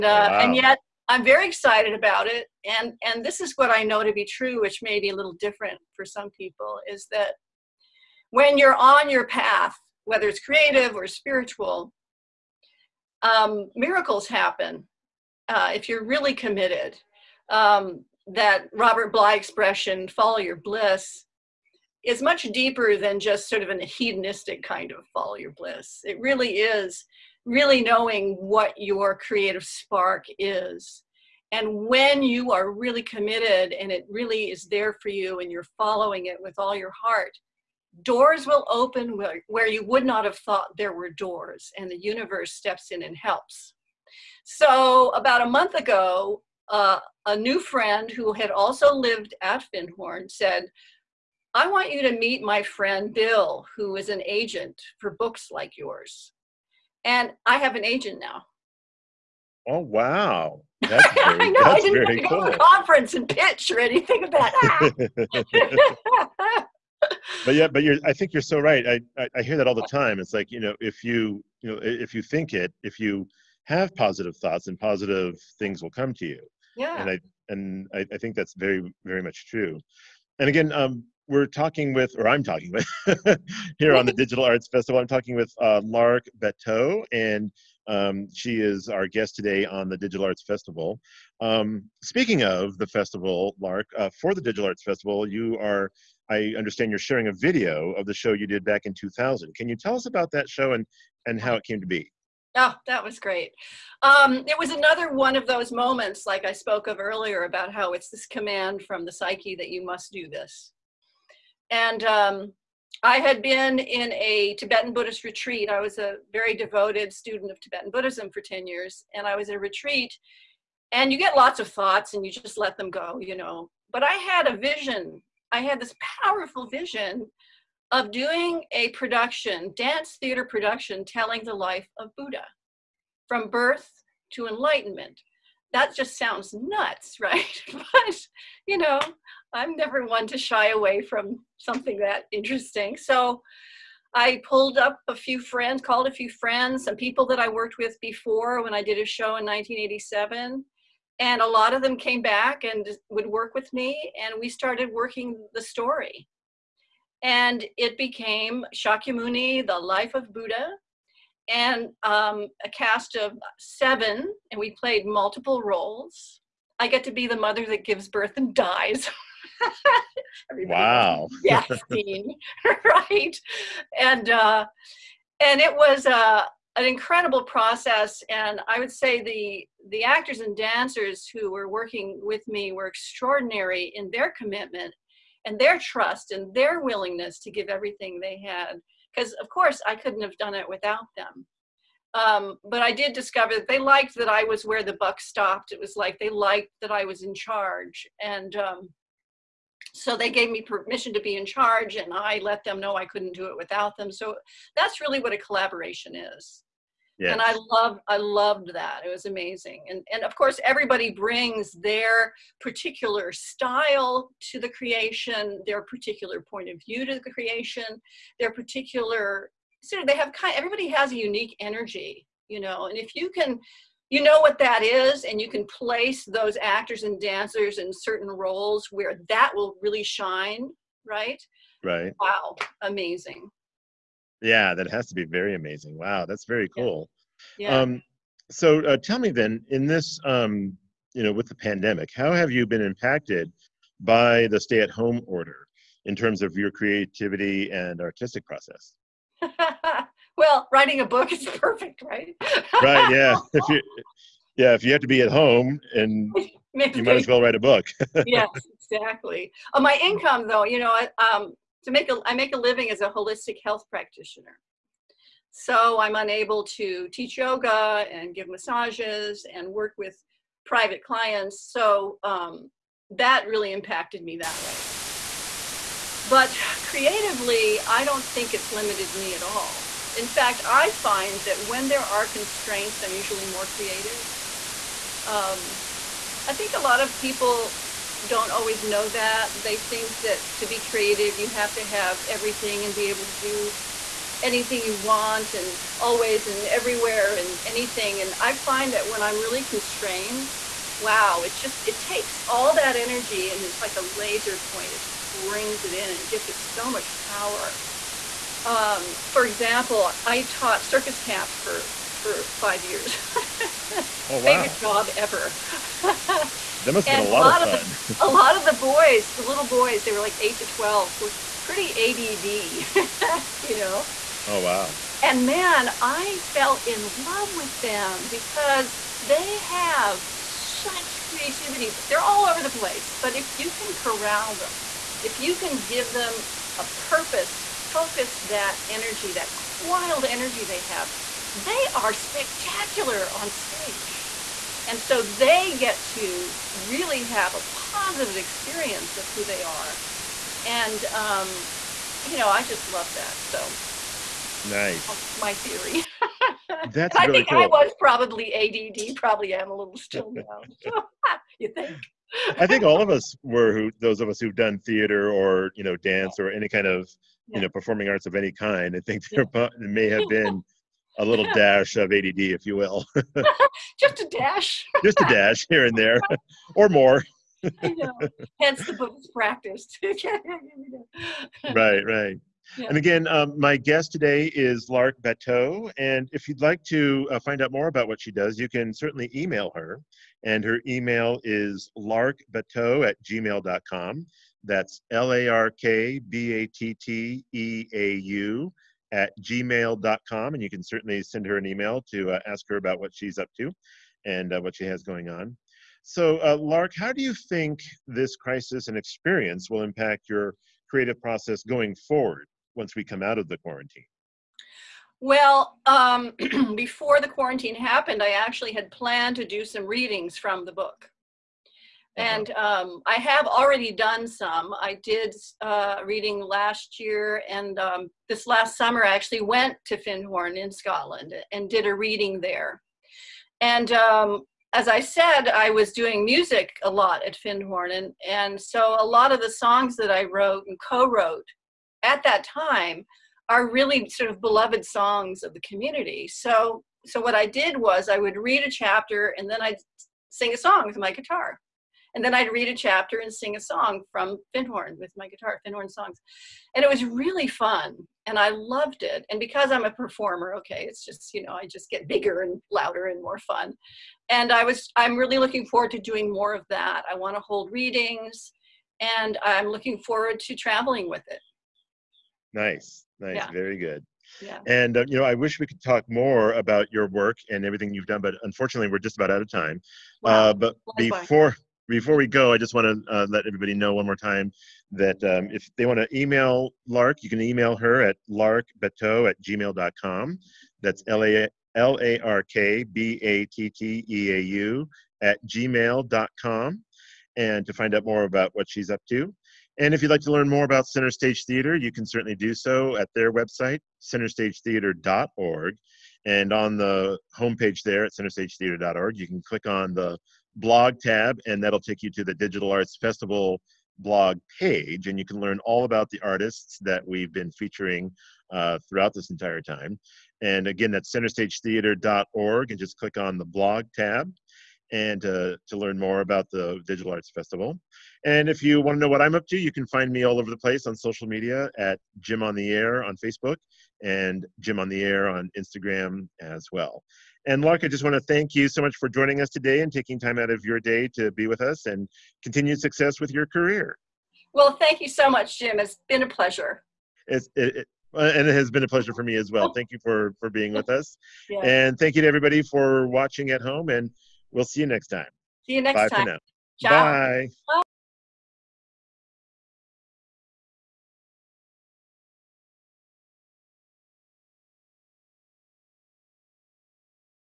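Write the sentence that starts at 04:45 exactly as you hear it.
Um, I think a lot of people don't always know that.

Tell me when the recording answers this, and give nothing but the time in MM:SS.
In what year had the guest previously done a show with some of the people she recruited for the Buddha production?
02:29.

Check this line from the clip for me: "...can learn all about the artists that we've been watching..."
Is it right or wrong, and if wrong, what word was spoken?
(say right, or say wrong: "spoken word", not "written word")
wrong: "featuring", not "watching".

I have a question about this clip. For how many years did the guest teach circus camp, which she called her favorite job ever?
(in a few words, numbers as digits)
5.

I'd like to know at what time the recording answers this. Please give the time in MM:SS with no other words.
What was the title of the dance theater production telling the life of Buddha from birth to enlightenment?
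02:38.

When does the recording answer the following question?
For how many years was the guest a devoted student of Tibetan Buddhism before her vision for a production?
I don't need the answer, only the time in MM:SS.
01:58.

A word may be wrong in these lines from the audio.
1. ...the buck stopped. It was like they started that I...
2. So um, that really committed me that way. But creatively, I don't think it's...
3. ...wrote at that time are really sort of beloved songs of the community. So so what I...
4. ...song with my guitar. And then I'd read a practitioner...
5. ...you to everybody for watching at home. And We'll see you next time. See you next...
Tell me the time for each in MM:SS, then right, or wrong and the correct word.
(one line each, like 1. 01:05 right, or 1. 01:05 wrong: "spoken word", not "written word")
1. 03:14 wrong: "liked", not "started"
2. 04:31 wrong: "impacted", not "committed"
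3. 07:21 right
4. 07:30 wrong: "chapter", not "practitioner"
5. 09:12 right.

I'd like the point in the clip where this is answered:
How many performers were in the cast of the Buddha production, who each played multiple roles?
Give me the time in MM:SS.
02:43.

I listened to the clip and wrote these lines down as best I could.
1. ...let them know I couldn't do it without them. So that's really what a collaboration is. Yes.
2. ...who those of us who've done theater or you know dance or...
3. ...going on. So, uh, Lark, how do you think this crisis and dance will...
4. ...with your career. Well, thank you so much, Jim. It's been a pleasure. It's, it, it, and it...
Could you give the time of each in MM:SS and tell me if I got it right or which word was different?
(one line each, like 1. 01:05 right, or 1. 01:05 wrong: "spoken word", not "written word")
1. 03:22 right
2. 06:03 right
3. 06:45 wrong: "experience", not "dance"
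4. 09:03 right.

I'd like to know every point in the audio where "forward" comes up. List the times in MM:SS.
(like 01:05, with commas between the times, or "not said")
06:51, 07:45, 07:49.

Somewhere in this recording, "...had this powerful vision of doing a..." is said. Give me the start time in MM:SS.
02:05.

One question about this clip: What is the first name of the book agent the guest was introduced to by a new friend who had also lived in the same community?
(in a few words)
Bill.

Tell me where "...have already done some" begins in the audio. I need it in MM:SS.
07:03.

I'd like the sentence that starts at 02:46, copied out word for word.
I get to be the mother that gives birth and dies.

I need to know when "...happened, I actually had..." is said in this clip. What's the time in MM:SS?
06:57.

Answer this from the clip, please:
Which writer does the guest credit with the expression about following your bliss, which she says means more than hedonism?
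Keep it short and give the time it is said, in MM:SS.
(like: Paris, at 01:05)
Robert Bly, at 00:18.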